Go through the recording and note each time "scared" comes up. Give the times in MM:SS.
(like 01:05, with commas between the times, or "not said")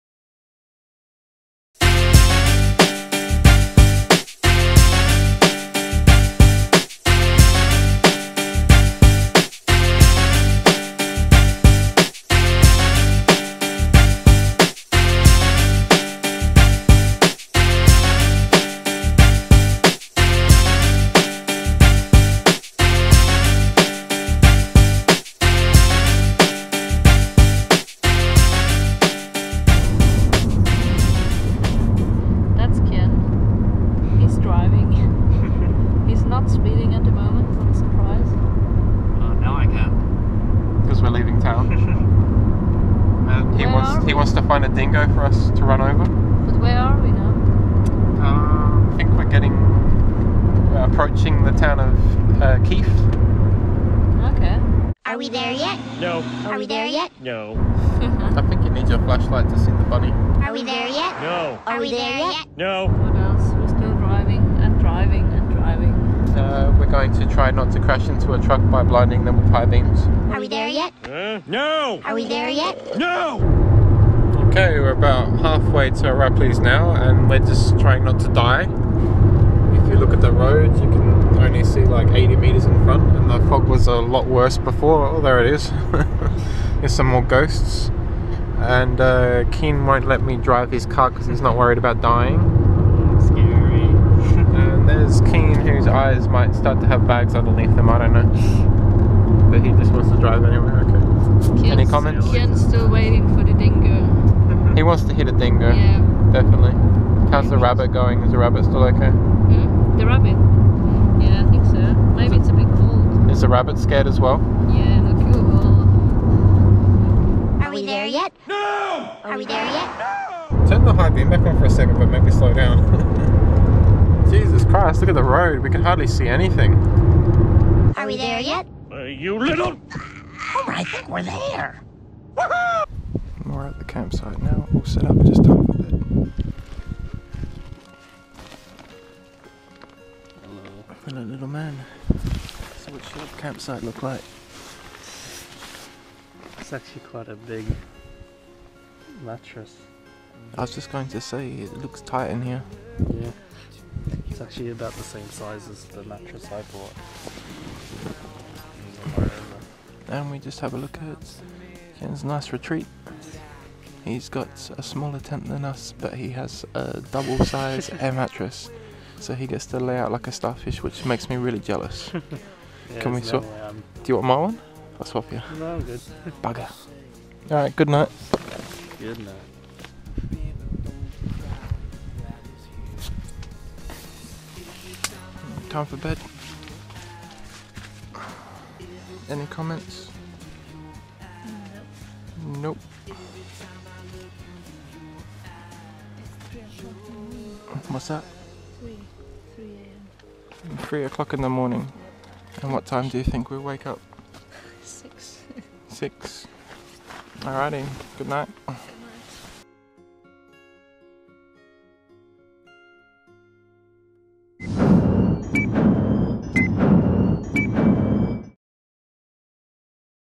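01:53.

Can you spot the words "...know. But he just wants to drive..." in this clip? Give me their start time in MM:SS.
01:38.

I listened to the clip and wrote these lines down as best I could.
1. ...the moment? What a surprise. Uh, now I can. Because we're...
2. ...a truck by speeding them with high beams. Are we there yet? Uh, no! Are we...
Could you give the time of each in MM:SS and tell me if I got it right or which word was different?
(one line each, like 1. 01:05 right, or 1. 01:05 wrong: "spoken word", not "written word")
1. 00:37 right
2. 01:08 wrong: "blinding", not "speeding".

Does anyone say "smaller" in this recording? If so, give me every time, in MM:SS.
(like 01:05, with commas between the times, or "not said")
02:44.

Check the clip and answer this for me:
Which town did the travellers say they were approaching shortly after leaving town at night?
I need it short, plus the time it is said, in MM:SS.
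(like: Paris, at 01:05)
Keith, at 00:52.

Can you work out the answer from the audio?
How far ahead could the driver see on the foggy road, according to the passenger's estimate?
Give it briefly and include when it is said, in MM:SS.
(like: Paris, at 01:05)
80 meters, at 01:22.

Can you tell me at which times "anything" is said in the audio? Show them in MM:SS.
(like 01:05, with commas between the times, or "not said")
02:06.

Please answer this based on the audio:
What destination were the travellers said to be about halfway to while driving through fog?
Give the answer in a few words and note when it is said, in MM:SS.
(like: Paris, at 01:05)
Arapiles, at 01:16.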